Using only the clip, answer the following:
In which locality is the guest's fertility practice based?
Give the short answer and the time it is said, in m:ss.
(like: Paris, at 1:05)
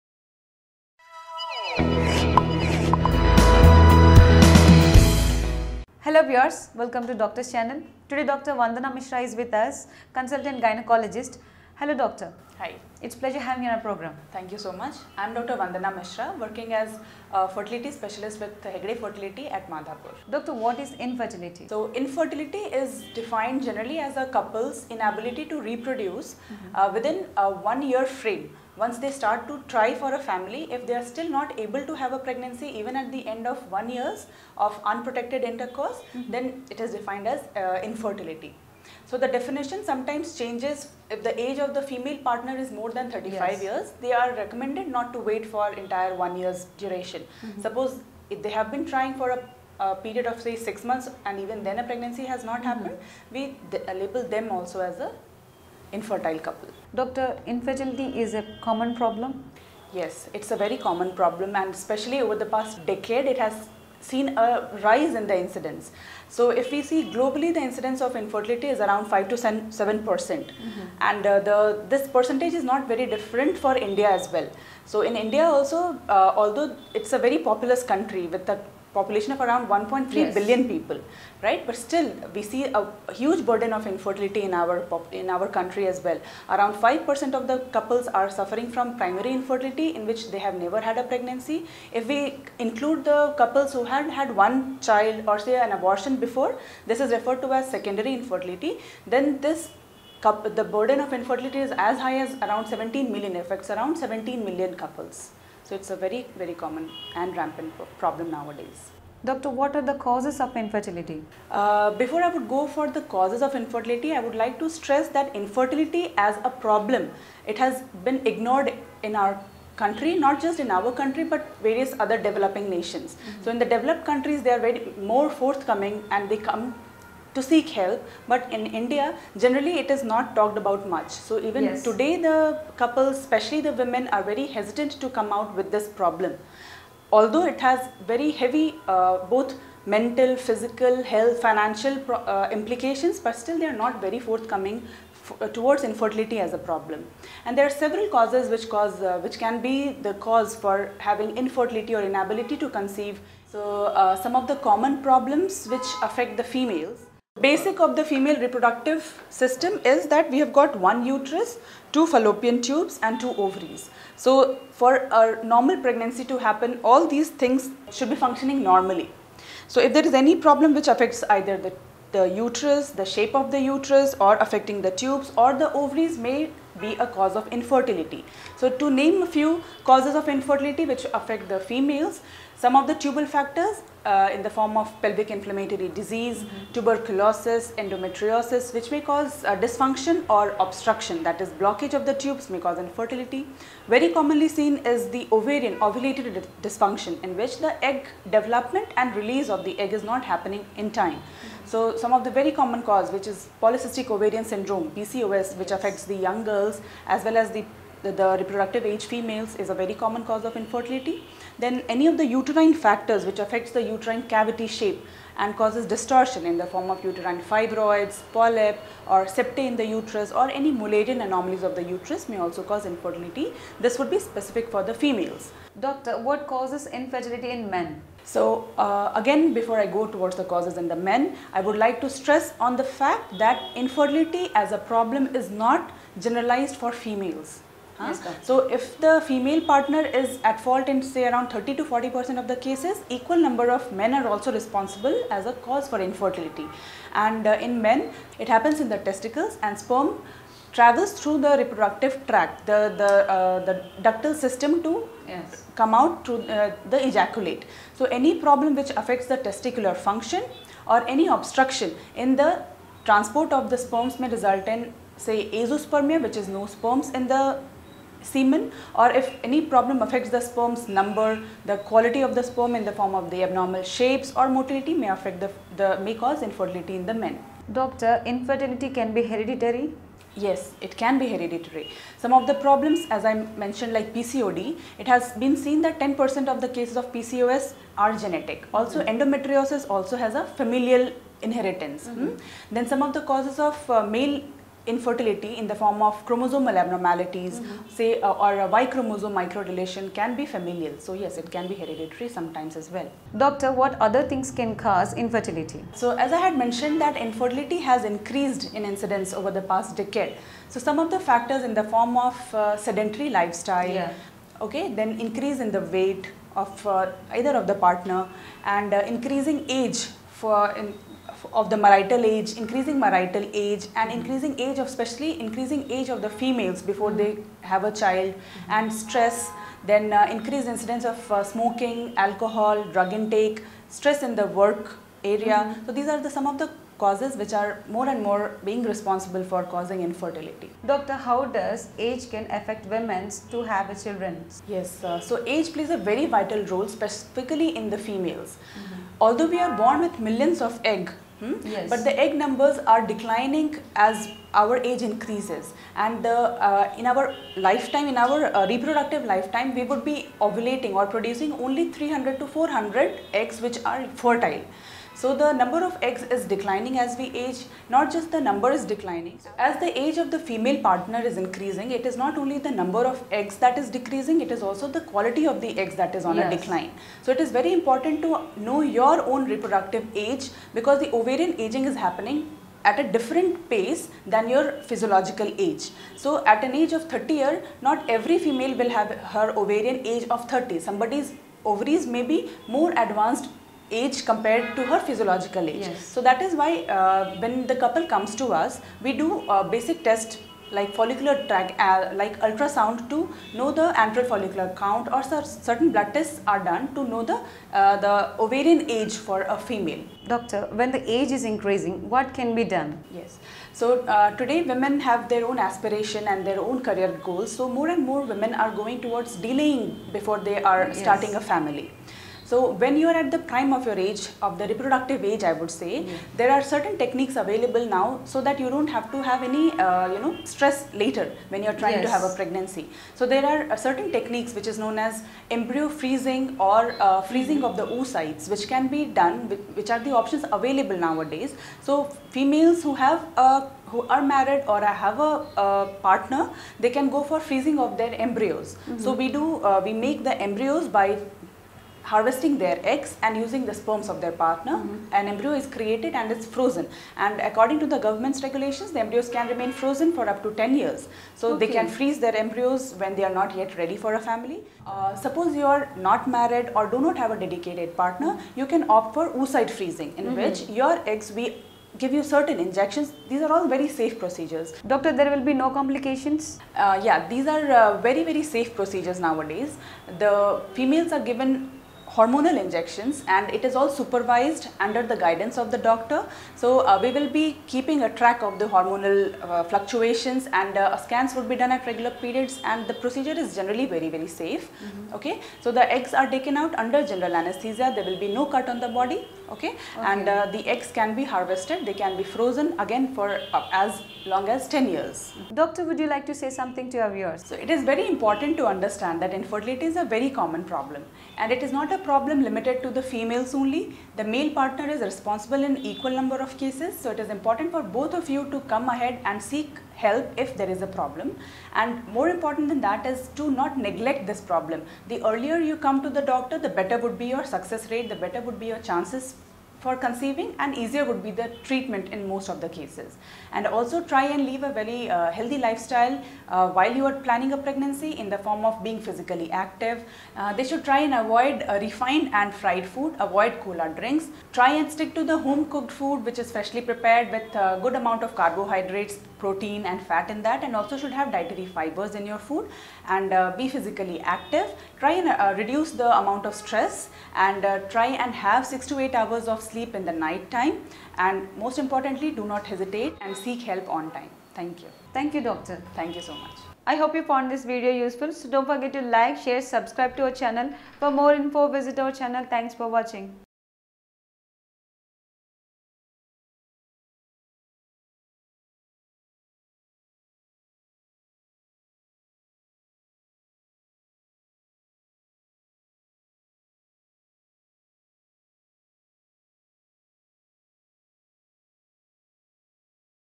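Madhapur, at 0:19.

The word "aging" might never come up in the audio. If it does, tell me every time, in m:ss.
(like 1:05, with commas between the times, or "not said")
6:21.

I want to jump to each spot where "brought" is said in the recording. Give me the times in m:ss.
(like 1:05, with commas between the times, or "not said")
not said.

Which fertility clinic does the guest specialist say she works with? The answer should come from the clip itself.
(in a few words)
Hegde Fertility.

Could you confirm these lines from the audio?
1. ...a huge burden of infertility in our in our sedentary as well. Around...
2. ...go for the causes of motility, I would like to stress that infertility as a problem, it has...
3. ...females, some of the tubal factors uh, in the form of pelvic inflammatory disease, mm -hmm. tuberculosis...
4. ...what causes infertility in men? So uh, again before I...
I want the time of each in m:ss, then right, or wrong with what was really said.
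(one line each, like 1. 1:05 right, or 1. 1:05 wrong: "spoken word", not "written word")
1. 1:23 wrong: "country", not "sedentary"
2. 1:52 wrong: "infertility", not "motility"
3. 3:01 right
4. 3:46 right.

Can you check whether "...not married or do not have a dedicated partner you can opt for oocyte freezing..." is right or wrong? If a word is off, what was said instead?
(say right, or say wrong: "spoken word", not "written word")
right.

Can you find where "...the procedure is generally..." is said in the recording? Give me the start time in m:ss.
8:12.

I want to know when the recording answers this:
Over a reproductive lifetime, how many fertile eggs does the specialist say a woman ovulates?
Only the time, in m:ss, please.
6:01.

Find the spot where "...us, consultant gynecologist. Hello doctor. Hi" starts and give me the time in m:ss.
0:09.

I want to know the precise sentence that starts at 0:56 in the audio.
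Doctor, infertility is a common problem?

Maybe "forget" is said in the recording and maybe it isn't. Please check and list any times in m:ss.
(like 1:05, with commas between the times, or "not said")
9:28.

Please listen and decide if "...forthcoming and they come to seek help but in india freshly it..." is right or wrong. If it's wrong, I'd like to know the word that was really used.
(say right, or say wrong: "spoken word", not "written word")
wrong: "generally", not "freshly".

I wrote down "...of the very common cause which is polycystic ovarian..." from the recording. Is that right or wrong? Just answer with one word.
right.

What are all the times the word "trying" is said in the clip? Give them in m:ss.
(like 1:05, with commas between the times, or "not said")
0:48, 7:11.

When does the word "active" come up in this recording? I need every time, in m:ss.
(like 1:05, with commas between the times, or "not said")
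8:59, 9:14.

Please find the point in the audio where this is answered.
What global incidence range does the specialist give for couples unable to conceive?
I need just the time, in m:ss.
1:09.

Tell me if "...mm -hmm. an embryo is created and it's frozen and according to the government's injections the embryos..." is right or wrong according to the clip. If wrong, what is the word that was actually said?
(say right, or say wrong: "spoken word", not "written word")
wrong: "regulations", not "injections".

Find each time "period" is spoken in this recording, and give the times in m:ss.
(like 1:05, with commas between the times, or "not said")
0:49, 8:12.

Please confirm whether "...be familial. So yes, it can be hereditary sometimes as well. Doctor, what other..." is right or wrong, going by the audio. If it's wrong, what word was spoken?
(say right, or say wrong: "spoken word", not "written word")
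right.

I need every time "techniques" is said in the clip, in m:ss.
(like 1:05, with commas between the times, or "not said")
7:06, 7:14.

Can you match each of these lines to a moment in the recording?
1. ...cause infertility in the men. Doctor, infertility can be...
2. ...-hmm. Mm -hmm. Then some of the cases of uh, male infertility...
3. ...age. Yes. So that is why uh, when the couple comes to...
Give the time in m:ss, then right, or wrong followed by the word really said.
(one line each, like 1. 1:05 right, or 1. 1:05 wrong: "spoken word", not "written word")
1. 4:36 right
2. 4:52 wrong: "causes", not "cases"
3. 6:35 right.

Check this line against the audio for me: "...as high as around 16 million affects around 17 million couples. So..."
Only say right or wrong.
wrong.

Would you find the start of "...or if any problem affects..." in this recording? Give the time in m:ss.
4:28.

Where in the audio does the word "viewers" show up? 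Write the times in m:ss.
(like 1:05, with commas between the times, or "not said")
0:06, 8:27.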